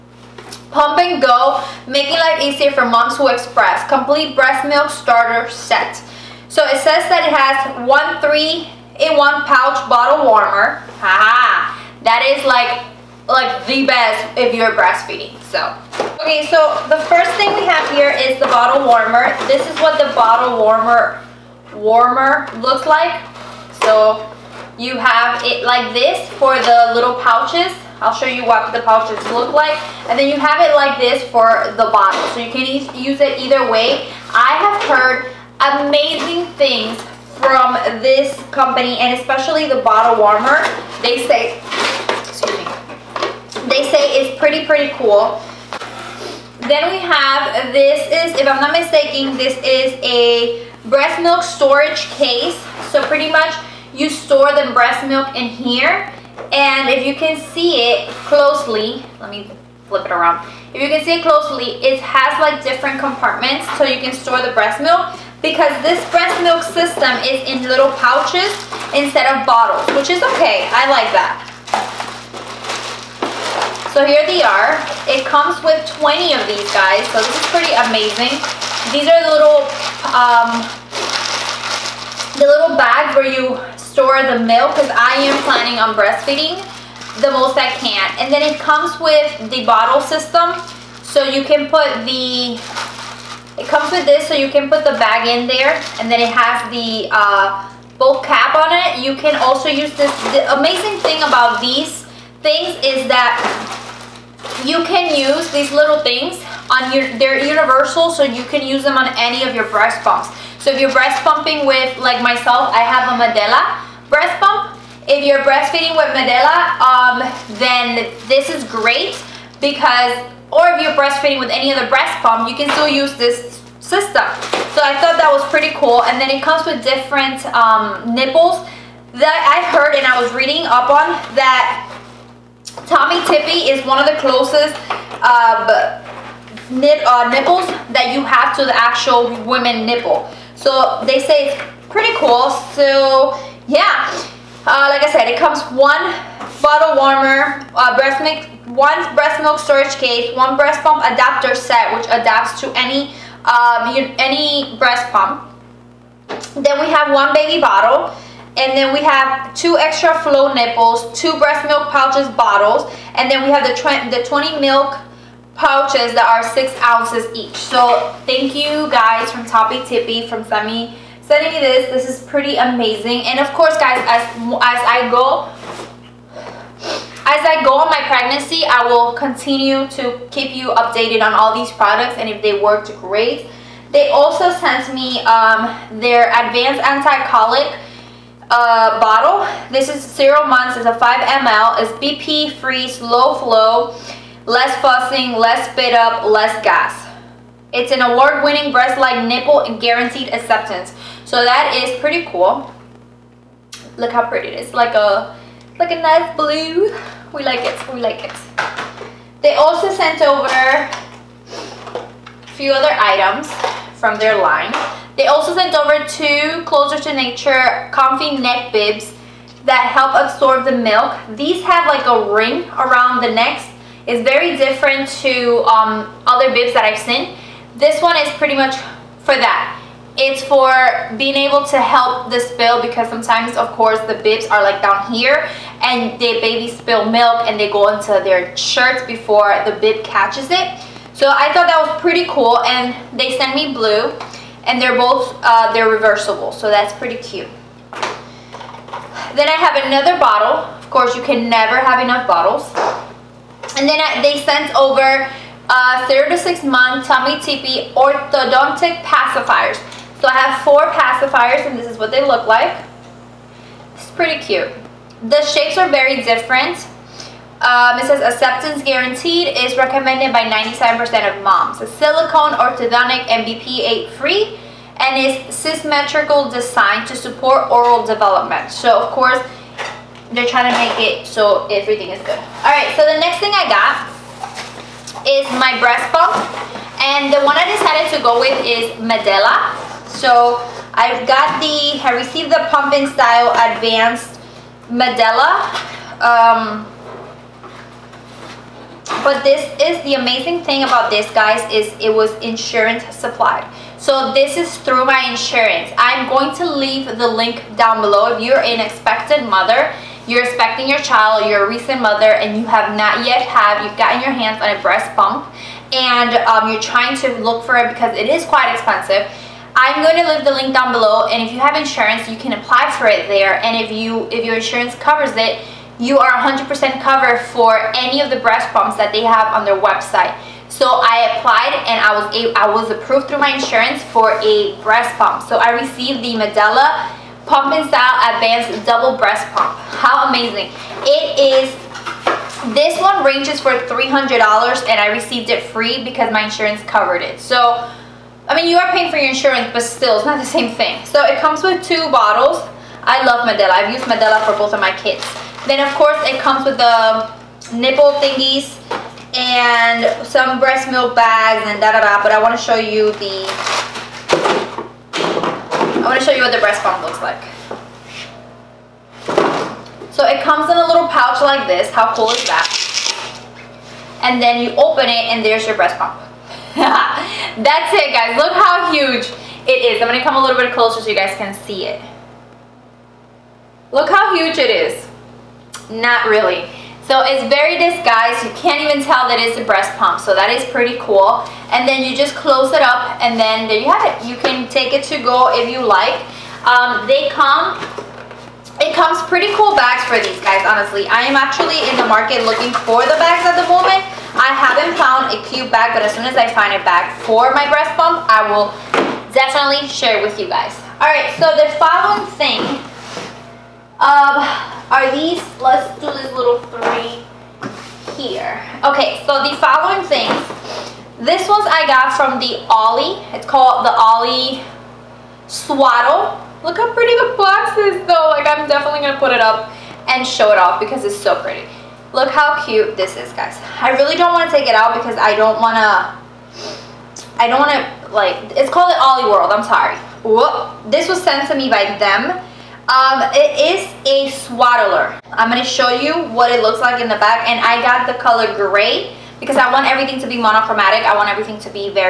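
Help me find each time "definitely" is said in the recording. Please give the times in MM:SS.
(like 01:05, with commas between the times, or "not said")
06:49, 07:08.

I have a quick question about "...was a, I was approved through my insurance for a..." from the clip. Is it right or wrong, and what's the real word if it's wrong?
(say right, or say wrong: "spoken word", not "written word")
right.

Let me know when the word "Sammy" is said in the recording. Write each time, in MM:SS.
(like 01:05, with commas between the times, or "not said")
02:50.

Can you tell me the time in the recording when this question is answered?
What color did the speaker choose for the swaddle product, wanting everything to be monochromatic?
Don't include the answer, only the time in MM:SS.
07:28.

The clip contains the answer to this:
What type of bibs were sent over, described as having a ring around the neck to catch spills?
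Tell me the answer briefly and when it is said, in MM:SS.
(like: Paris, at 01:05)
Comfy neck bibs, at 03:37.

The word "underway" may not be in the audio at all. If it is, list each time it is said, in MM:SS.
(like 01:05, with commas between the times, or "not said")
not said.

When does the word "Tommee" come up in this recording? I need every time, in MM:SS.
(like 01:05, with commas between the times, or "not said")
02:12, 04:17.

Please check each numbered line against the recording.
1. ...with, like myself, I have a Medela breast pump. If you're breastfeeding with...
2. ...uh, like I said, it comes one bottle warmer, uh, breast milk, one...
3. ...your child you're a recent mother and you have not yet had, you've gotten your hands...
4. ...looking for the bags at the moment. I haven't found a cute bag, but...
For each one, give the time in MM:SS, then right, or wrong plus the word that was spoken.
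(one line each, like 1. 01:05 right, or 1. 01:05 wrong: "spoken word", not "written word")
1. 01:51 right
2. 02:24 right
3. 05:10 right
4. 06:42 right.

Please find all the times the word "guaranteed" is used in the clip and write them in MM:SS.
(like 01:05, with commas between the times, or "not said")
03:19, 04:28.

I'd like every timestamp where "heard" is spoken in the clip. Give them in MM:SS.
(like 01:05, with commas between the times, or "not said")
00:34, 02:09.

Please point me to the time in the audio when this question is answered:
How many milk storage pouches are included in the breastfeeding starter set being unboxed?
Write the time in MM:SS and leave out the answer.
01:16.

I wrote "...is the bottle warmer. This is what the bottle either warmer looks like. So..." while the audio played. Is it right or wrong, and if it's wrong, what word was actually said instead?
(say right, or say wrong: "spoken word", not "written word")
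wrong: "warmer", not "either".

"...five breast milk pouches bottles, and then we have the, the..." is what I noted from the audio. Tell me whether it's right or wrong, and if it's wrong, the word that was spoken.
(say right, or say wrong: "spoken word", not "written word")
wrong: "two", not "five".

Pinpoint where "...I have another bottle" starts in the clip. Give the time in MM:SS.
04:09.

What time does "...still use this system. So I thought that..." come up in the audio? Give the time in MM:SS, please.
02:02.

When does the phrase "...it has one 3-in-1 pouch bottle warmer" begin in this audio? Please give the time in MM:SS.
00:07.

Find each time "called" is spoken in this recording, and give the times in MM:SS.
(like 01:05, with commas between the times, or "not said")
07:03, 07:18.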